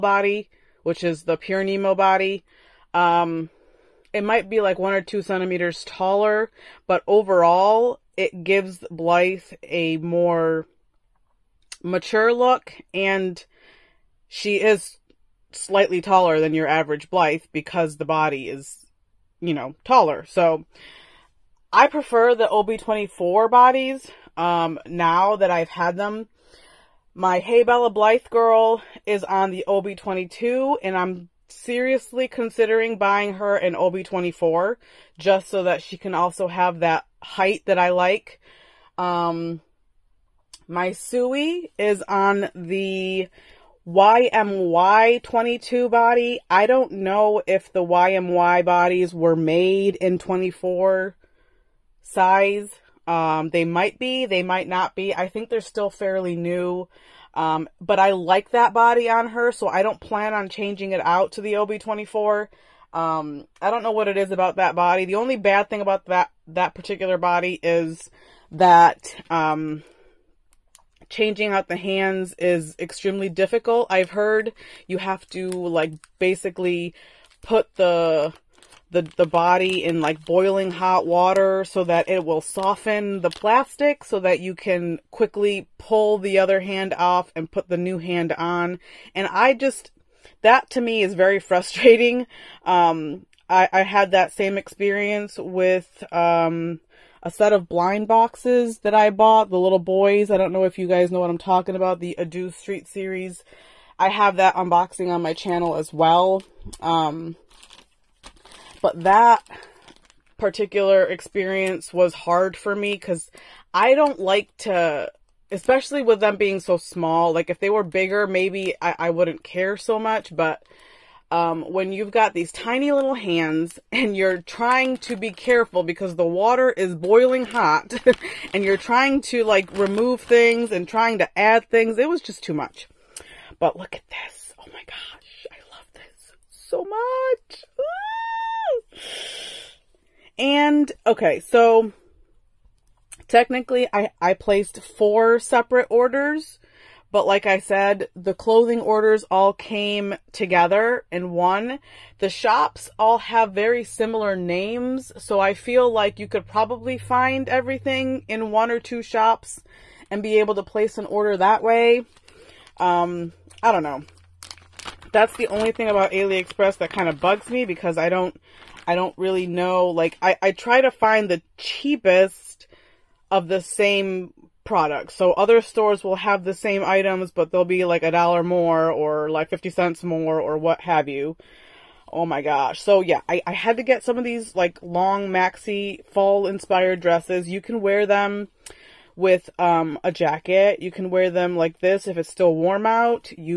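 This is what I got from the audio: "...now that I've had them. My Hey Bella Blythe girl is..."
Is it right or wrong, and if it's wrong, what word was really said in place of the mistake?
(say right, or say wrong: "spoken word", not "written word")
right.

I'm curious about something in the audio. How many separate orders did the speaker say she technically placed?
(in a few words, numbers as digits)
4.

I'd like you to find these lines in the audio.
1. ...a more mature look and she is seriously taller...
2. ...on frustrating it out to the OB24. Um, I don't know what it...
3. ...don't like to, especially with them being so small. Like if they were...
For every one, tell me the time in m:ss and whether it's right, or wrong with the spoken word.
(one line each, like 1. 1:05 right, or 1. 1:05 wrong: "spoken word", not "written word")
1. 0:09 wrong: "slightly", not "seriously"
2. 1:00 wrong: "changing", not "frustrating"
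3. 1:53 right.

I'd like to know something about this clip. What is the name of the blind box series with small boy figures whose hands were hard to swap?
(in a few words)
Adu Street.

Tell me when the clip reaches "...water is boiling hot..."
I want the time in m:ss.
2:06.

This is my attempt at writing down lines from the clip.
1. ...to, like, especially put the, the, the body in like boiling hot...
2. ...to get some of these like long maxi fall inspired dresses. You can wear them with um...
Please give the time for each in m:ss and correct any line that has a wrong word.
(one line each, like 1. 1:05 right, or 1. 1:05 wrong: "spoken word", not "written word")
1. 1:15 wrong: "basically", not "especially"
2. 3:03 right.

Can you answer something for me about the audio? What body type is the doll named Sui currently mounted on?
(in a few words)
YMY 22.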